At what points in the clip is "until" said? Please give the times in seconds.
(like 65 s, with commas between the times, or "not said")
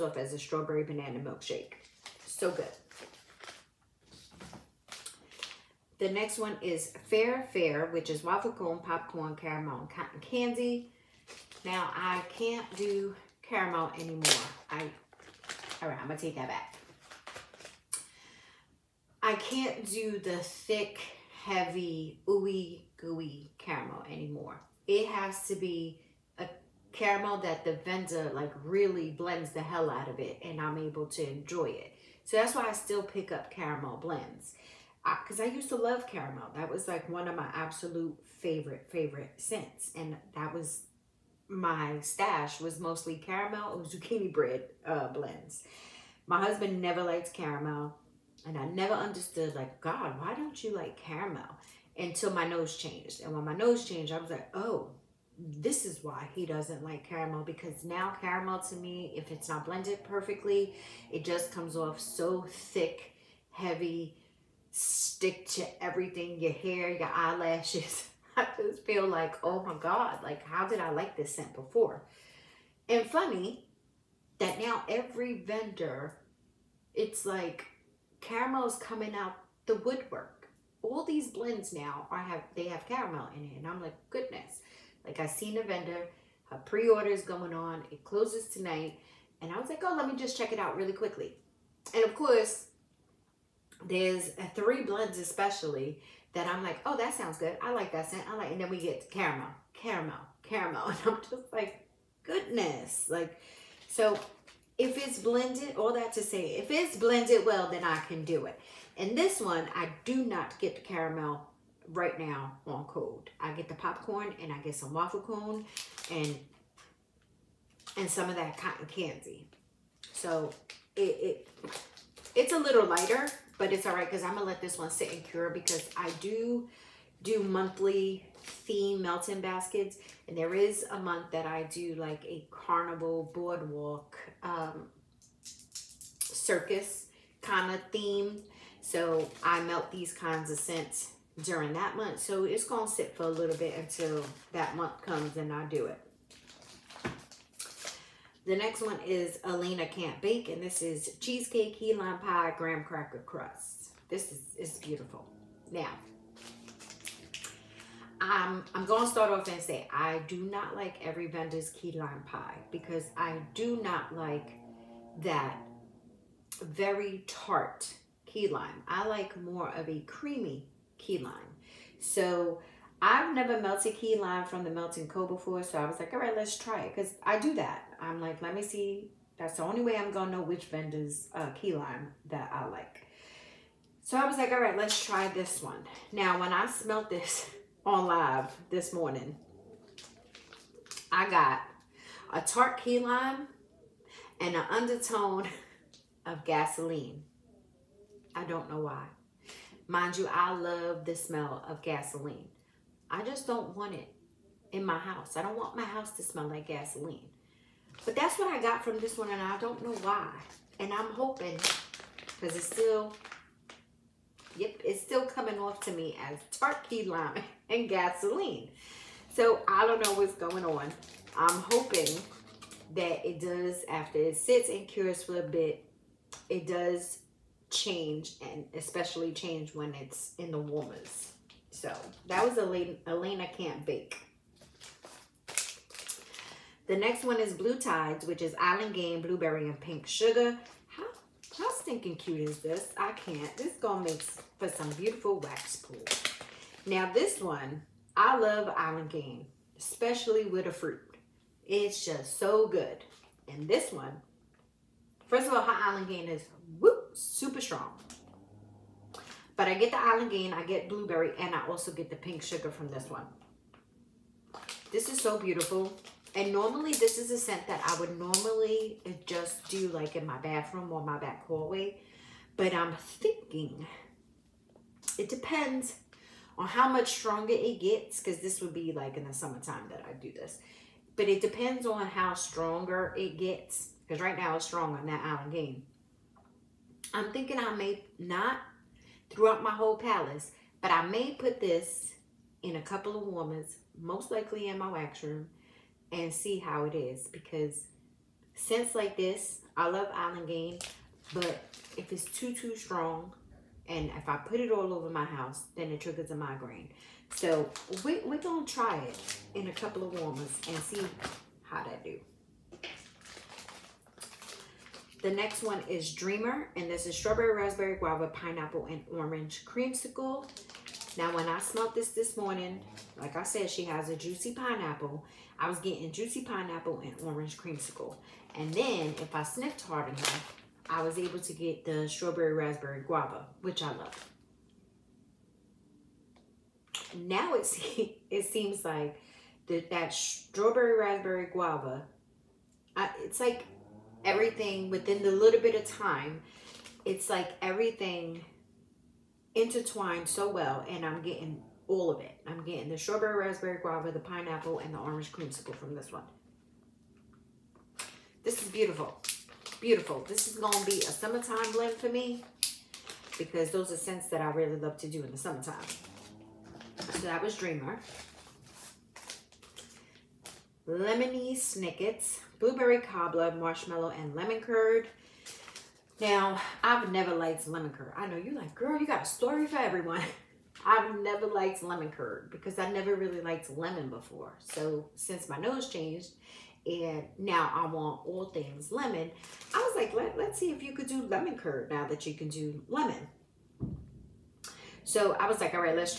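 51 s, 143 s.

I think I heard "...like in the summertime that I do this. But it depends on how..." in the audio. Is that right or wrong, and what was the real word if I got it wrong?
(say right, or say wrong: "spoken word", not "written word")
right.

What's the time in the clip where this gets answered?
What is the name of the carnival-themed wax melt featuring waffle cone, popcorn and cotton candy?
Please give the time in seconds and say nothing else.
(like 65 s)
7 s.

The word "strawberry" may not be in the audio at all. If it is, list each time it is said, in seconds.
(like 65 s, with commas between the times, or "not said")
0 s, 317 s, 332 s, 340 s, 352 s.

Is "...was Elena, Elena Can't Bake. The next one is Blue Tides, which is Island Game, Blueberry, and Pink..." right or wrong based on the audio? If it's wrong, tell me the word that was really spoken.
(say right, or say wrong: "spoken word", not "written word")
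right.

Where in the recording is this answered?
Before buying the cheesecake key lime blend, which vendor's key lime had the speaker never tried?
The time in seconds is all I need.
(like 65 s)
174 s.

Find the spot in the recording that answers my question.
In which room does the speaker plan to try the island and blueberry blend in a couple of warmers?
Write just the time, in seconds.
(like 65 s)
294 s.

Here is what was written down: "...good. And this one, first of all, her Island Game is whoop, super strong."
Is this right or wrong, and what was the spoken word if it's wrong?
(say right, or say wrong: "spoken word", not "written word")
right.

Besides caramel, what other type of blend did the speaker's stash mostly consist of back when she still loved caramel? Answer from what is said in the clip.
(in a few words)
zucchini bread.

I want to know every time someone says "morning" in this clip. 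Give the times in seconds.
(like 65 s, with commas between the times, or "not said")
188 s, 322 s.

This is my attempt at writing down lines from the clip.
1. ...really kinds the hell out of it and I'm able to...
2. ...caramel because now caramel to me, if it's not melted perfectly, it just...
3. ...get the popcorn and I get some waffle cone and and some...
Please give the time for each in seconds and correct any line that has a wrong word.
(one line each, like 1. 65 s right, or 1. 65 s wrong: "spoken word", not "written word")
1. 28 s wrong: "blends", not "kinds"
2. 57 s wrong: "blended", not "melted"
3. 113 s right.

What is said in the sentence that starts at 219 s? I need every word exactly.
So I don't know what's going on.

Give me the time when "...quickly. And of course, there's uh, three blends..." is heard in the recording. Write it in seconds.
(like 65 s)
90 s.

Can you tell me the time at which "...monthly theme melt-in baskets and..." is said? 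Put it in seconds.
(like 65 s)
127 s.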